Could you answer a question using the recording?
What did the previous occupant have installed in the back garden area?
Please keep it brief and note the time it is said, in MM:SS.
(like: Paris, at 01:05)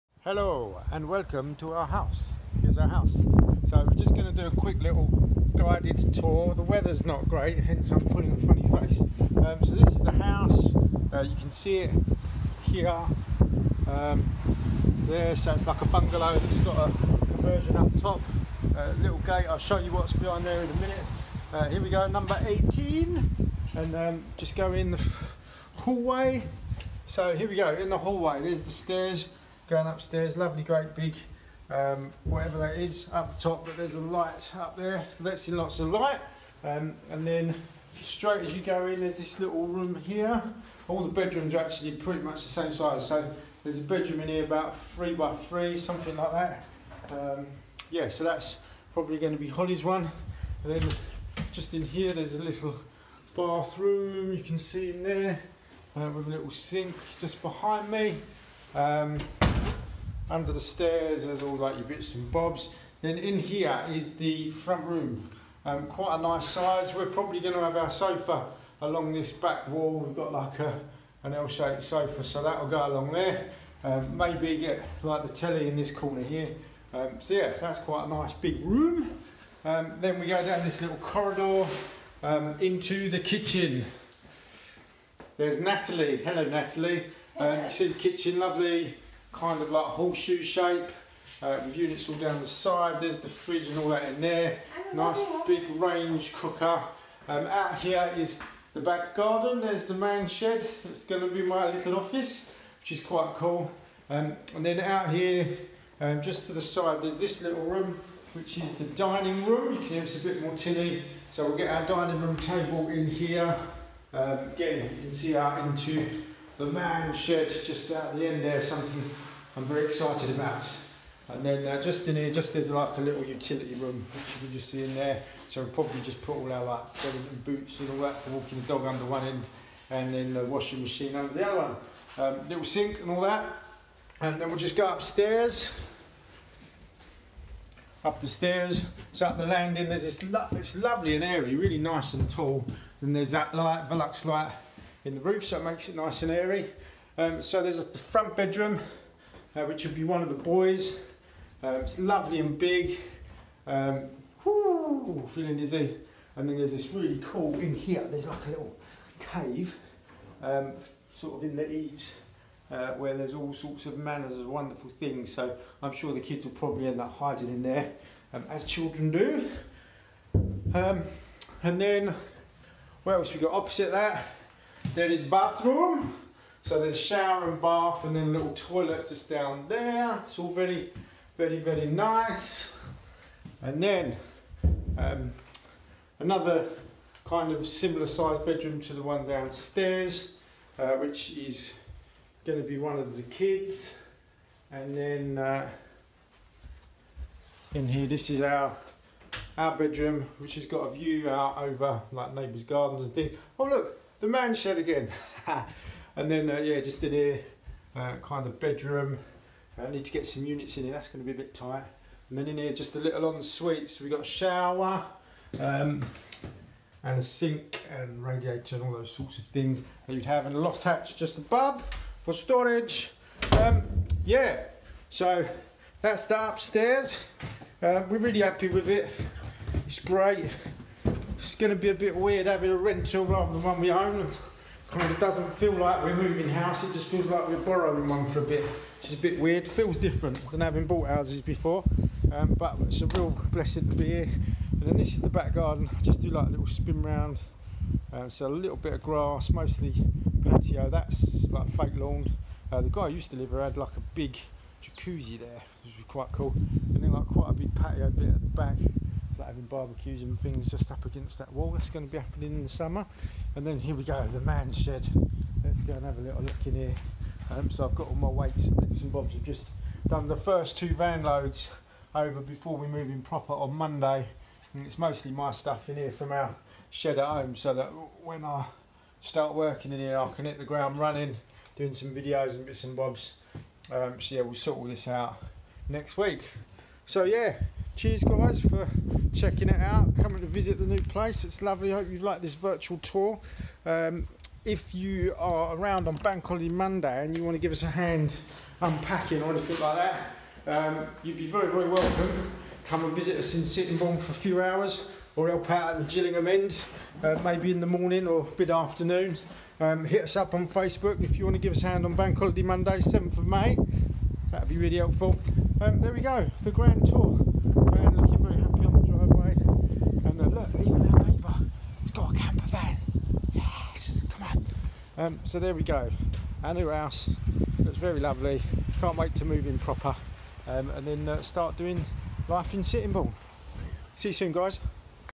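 Jacuzzi, at 04:14.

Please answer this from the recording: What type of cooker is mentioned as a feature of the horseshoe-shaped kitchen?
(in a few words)
Range cooker.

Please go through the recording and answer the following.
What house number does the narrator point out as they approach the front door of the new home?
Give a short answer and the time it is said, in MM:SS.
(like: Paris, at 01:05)
18, at 00:22.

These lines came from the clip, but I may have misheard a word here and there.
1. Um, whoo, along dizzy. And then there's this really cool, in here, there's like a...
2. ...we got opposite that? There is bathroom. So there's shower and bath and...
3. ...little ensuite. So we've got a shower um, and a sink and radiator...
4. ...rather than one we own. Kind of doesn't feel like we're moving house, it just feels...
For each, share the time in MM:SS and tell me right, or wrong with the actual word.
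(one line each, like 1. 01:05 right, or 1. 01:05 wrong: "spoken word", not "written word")
1. 02:33 wrong: "feeling", not "along"
2. 02:53 right
3. 03:32 right
4. 03:53 right.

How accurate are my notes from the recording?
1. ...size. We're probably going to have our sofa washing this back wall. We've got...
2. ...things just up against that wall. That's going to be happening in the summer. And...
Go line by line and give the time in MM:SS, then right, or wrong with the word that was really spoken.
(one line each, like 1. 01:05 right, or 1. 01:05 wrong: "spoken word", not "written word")
1. 01:06 wrong: "along", not "washing"
2. 04:20 right.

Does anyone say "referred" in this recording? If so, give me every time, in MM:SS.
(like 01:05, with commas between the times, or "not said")
not said.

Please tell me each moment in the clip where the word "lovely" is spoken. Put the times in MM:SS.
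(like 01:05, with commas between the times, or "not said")
00:30, 01:28, 02:20, 02:31, 04:51, 05:28.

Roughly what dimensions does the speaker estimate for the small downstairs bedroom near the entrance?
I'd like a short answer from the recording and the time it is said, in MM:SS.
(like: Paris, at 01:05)
3 by 3, at 00:44.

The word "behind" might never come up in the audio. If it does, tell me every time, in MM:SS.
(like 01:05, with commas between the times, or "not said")
00:20, 00:57.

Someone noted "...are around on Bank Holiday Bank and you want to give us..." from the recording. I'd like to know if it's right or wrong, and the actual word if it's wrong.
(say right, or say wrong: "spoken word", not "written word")
wrong: "Monday", not "Bank".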